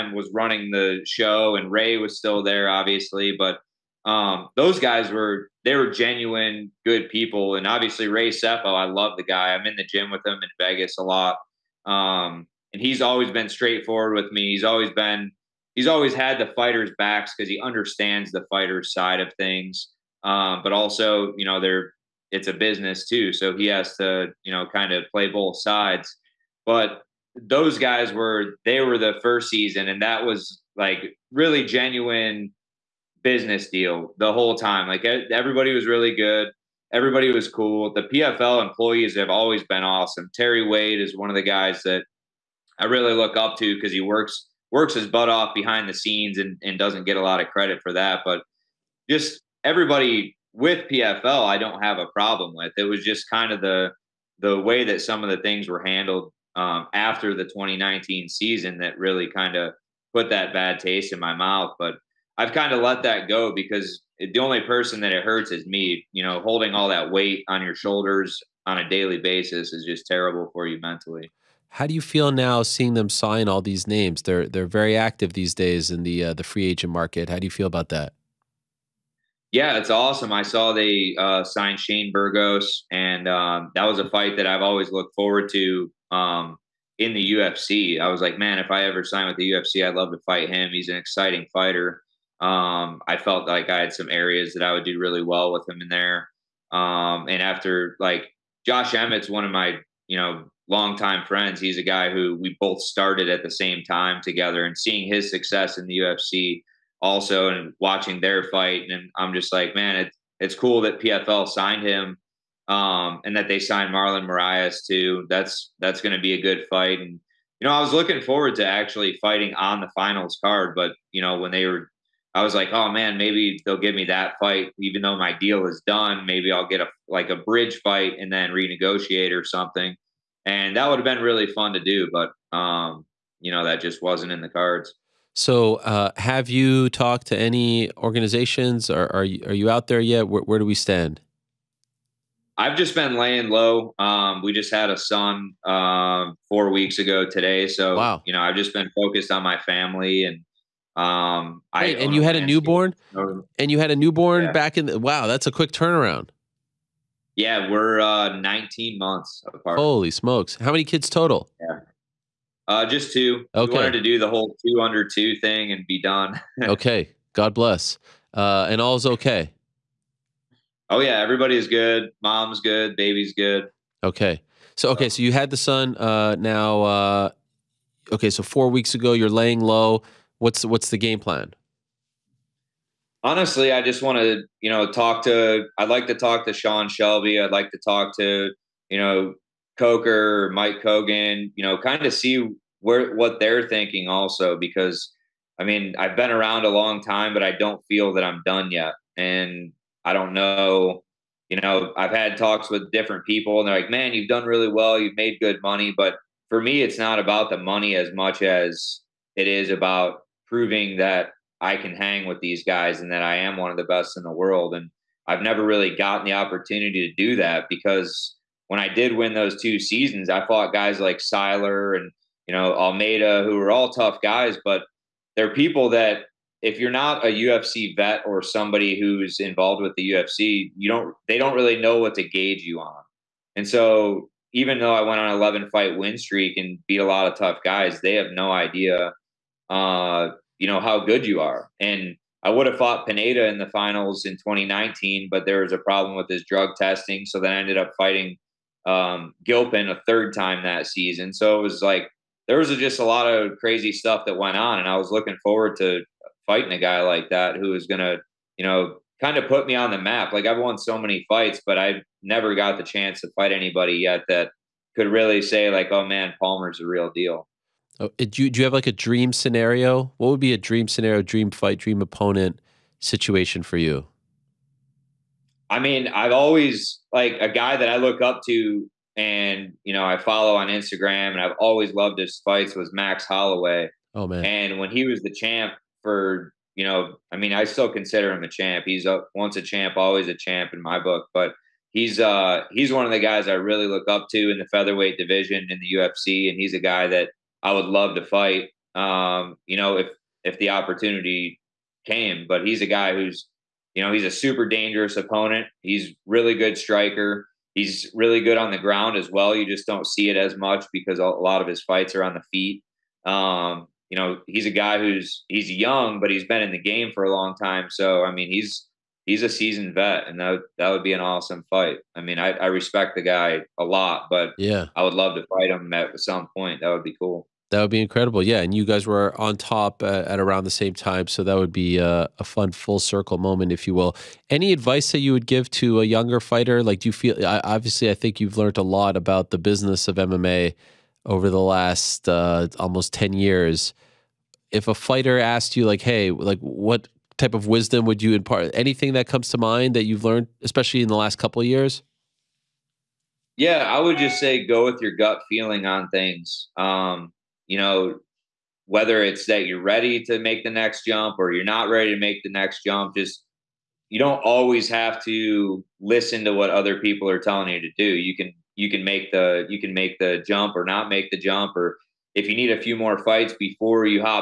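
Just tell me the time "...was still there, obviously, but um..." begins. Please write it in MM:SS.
00:01.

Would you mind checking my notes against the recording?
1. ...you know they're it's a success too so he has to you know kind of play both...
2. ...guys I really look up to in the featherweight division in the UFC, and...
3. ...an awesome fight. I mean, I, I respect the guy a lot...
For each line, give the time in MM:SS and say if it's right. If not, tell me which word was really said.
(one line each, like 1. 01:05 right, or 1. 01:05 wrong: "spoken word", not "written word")
1. 00:21 wrong: "business", not "success"
2. 04:53 right
3. 05:21 right.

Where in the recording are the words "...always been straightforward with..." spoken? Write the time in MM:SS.
00:13.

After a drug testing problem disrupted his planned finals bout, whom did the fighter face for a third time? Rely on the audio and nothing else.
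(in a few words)
Gilpin.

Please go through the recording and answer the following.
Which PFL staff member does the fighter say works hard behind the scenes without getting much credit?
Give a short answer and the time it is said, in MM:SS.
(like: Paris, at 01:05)
Terry Wade, at 00:40.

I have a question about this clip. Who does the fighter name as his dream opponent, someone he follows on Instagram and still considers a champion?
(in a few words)
Max Holloway.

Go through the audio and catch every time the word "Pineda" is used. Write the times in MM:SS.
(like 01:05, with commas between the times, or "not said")
04:03.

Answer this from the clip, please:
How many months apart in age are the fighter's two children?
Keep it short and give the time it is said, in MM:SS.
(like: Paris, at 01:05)
19, at 02:38.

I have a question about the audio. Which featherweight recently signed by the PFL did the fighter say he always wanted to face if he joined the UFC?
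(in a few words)
Shane Burgos.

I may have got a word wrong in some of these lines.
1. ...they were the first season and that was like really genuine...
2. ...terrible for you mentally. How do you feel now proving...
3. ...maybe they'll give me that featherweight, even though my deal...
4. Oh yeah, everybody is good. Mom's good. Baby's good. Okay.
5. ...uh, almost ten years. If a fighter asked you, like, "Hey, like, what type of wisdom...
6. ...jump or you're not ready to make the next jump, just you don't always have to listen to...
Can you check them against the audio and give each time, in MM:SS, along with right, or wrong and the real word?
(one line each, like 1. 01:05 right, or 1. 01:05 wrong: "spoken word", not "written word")
1. 00:28 right
2. 01:10 wrong: "seeing", not "proving"
3. 02:03 wrong: "fight", not "featherweight"
4. 02:50 right
5. 05:42 right
6. 06:01 right.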